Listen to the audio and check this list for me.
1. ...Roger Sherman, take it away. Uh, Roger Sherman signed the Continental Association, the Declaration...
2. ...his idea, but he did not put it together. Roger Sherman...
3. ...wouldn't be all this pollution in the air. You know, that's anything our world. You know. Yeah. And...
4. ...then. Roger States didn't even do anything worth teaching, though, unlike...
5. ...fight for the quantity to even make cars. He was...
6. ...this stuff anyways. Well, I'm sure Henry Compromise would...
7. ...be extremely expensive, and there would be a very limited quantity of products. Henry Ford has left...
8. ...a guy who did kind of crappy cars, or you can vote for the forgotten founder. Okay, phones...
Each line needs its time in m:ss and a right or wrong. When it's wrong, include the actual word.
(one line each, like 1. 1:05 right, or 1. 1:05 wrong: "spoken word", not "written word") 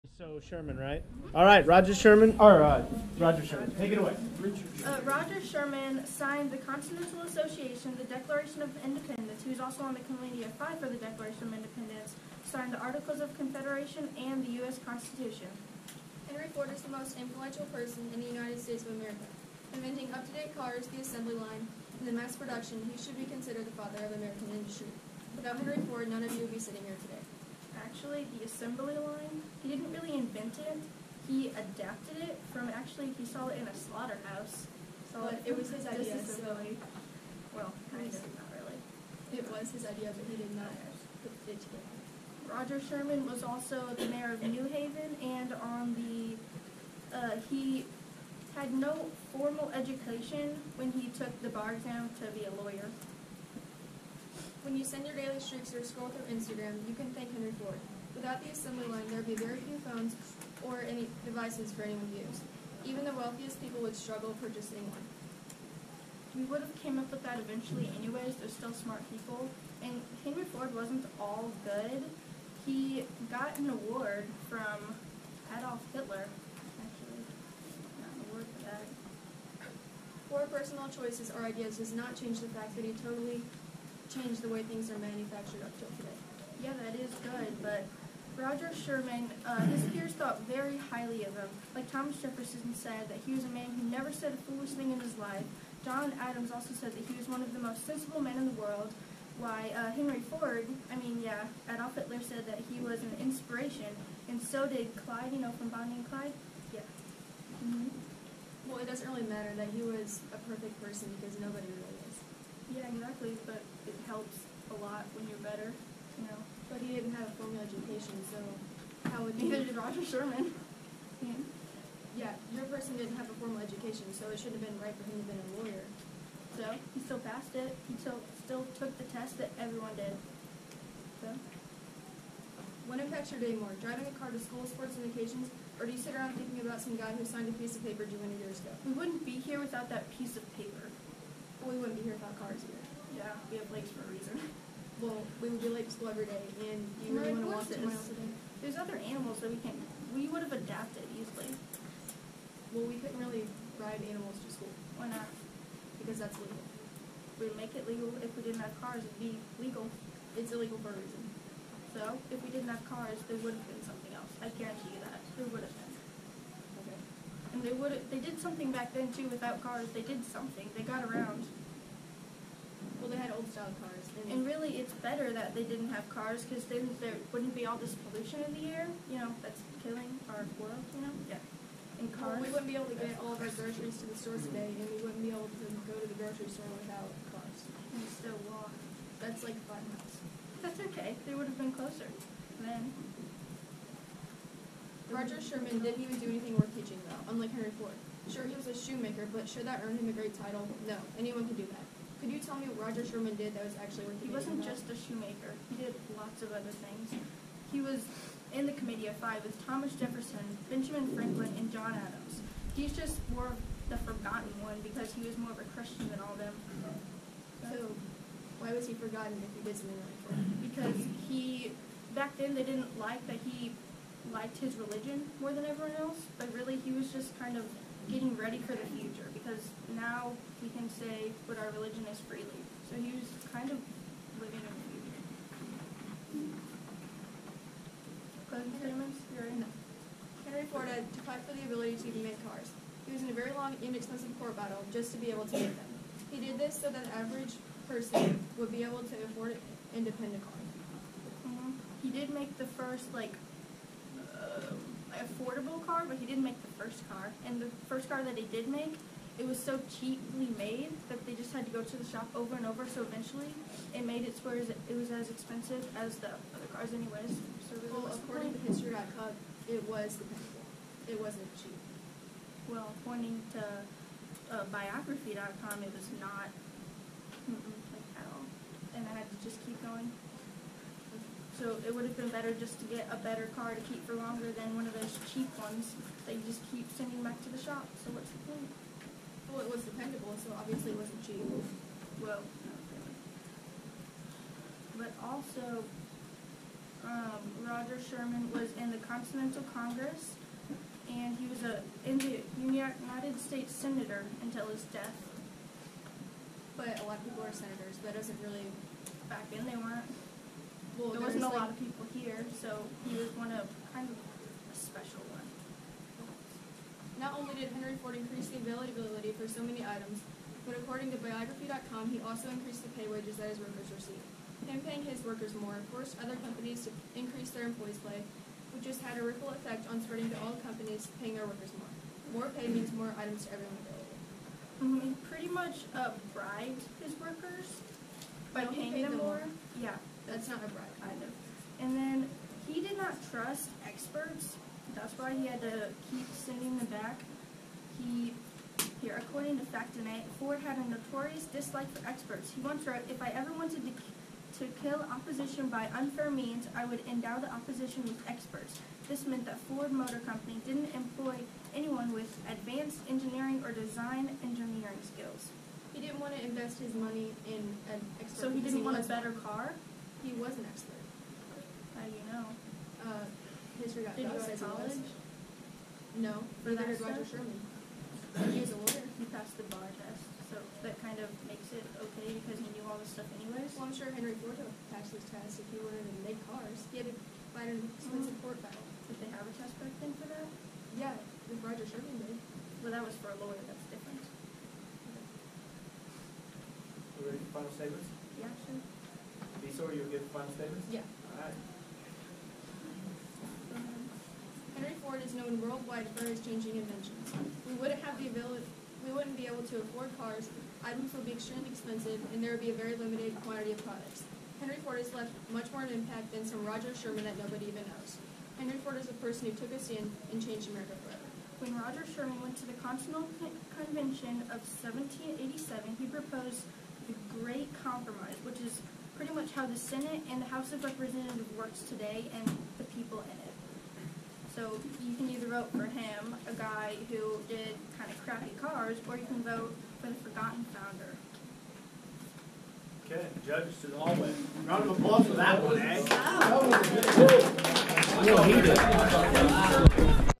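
1. 0:03 right
2. 0:39 right
3. 2:57 wrong: "killing", not "anything"
4. 3:12 wrong: "Sherman", not "States"
5. 4:01 wrong: "ability", not "quantity"
6. 6:23 wrong: "Ford", not "Compromise"
7. 6:51 right
8. 7:16 wrong: "judges", not "phones".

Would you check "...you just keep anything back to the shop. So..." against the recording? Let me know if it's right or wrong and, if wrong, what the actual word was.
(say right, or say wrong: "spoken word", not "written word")
wrong: "sending", not "anything".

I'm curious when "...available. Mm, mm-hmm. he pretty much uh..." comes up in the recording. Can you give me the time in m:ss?
5:33.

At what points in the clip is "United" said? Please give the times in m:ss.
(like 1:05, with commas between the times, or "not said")
0:18, 5:02.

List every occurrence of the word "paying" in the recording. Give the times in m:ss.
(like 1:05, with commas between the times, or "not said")
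5:24, 5:31, 5:38.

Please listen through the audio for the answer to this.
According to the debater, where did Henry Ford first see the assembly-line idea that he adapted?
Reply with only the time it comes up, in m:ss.
0:33.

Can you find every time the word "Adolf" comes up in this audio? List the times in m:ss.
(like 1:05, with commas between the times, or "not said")
1:15, 1:41.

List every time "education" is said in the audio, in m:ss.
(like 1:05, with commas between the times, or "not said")
0:49, 1:57, 2:03.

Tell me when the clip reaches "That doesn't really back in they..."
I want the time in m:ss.
5:08.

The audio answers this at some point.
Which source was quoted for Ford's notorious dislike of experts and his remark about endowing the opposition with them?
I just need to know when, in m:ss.
5:49.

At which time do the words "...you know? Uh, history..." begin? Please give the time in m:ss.
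6:12.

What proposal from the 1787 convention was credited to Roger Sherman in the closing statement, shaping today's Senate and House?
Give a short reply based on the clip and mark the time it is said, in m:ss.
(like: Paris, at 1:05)
The Great Compromise, at 7:07.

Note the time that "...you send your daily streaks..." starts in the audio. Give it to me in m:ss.
0:54.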